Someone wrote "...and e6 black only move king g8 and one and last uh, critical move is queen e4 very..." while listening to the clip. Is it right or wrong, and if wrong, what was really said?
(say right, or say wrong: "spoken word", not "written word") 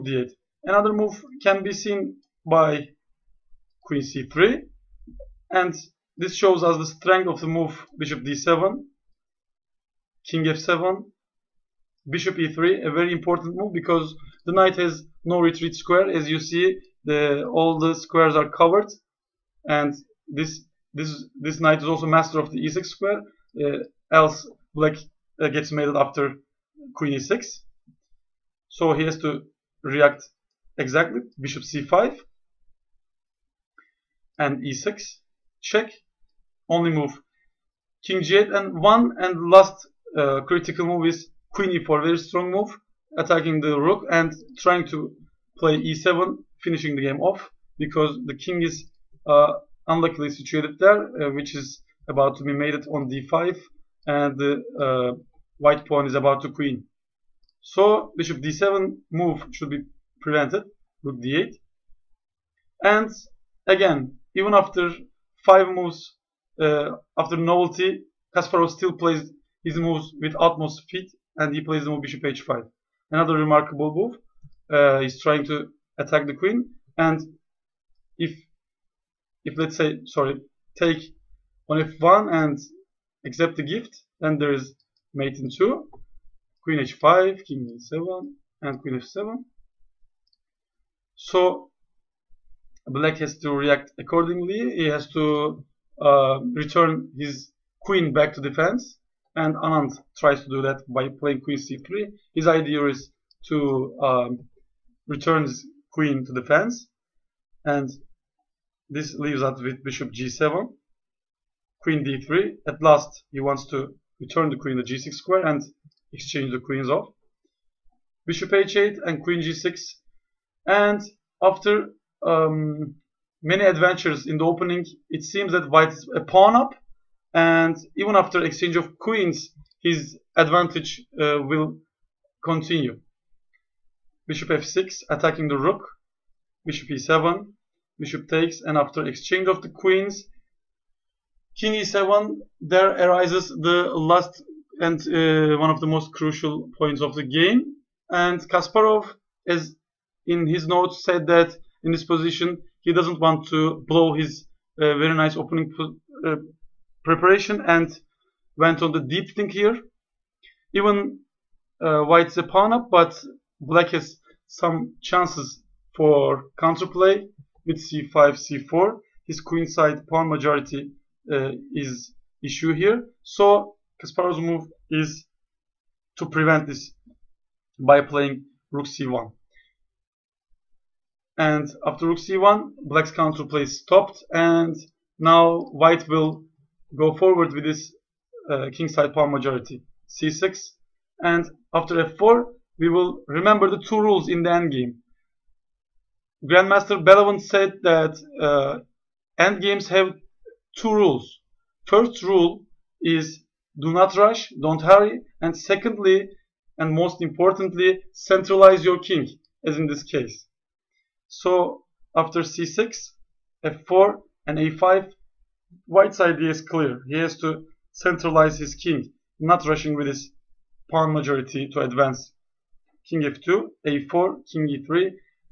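wrong: "check", not "black".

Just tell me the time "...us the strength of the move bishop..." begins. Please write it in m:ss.
0:06.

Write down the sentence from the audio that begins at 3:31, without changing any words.
So after c6, f4, and a5, white's idea is clear.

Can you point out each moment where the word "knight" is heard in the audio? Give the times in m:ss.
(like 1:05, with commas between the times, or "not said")
0:14, 0:21.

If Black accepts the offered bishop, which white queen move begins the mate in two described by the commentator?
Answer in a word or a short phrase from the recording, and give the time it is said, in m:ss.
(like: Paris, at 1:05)
Queen h5, at 1:26.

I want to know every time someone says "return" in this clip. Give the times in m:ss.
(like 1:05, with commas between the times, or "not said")
1:36, 1:45, 1:54.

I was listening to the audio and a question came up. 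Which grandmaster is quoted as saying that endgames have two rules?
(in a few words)
Belovin.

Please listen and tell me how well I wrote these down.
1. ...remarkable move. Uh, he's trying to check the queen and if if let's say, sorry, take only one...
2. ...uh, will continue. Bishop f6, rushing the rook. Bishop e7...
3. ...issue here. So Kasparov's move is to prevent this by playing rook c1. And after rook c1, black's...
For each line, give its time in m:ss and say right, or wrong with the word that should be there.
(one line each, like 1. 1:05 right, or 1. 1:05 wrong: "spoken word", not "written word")
1. 1:13 wrong: "attack", not "check"
2. 2:11 wrong: "attacking", not "rushing"
3. 2:52 right.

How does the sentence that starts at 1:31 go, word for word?
So black has to react accordingly.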